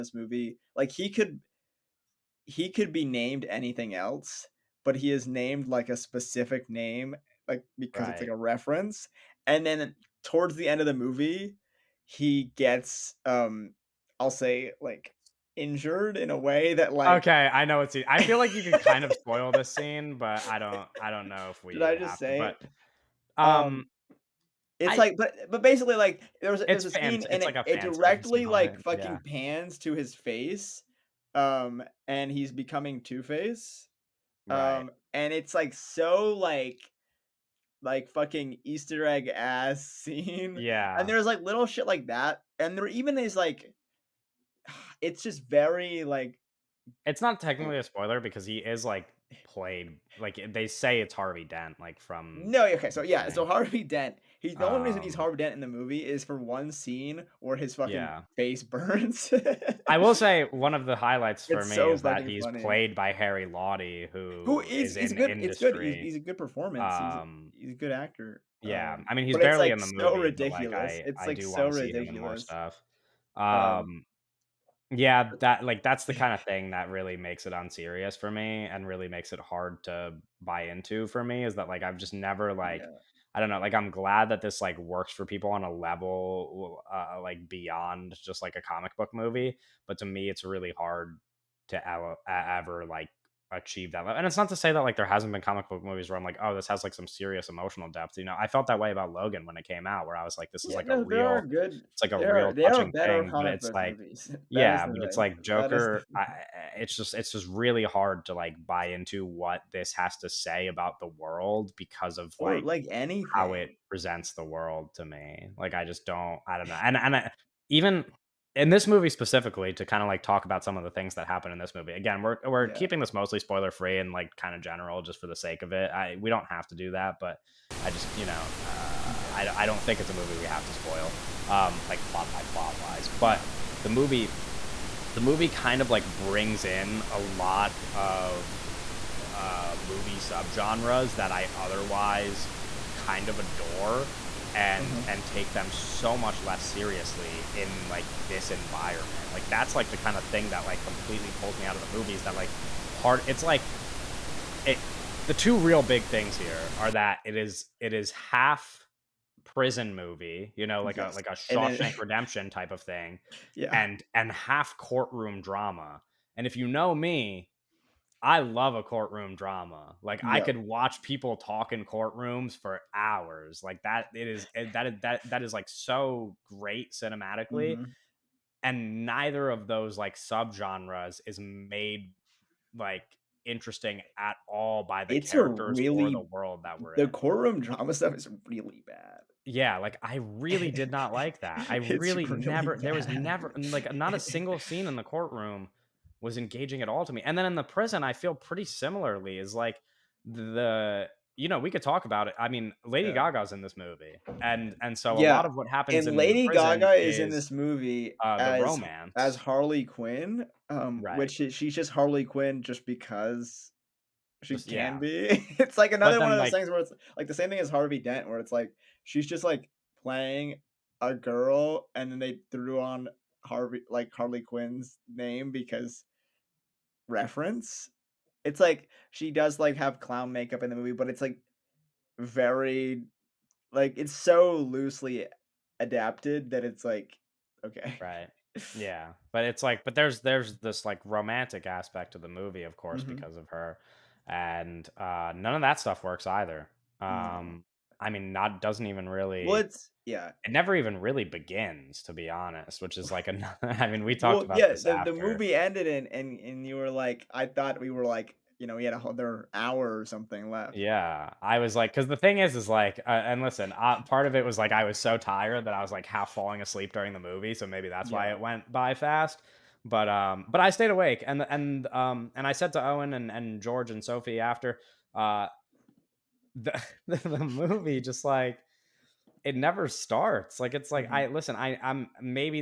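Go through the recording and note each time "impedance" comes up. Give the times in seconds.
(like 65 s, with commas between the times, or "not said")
not said.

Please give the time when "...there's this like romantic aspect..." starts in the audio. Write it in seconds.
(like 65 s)
240 s.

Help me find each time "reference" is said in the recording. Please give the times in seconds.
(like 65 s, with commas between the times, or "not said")
8 s, 227 s.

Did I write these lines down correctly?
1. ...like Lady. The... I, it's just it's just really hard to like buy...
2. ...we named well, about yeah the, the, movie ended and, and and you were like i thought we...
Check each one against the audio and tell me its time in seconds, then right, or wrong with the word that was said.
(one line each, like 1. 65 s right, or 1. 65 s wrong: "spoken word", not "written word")
1. 105 s wrong: "Joker", not "Lady"
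2. 254 s wrong: "talked", not "named".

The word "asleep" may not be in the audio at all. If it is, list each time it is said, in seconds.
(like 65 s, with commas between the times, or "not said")
266 s.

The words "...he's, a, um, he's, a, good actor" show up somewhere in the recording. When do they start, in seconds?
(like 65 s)
66 s.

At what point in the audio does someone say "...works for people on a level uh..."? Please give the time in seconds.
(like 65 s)
84 s.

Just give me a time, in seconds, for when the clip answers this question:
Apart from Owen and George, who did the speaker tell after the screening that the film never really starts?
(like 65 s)
274 s.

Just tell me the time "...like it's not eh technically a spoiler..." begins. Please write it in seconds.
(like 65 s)
46 s.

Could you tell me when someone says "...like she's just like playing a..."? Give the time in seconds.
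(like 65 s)
218 s.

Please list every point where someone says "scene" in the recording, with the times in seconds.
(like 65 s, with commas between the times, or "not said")
19 s, 26 s, 40 s, 56 s, 194 s.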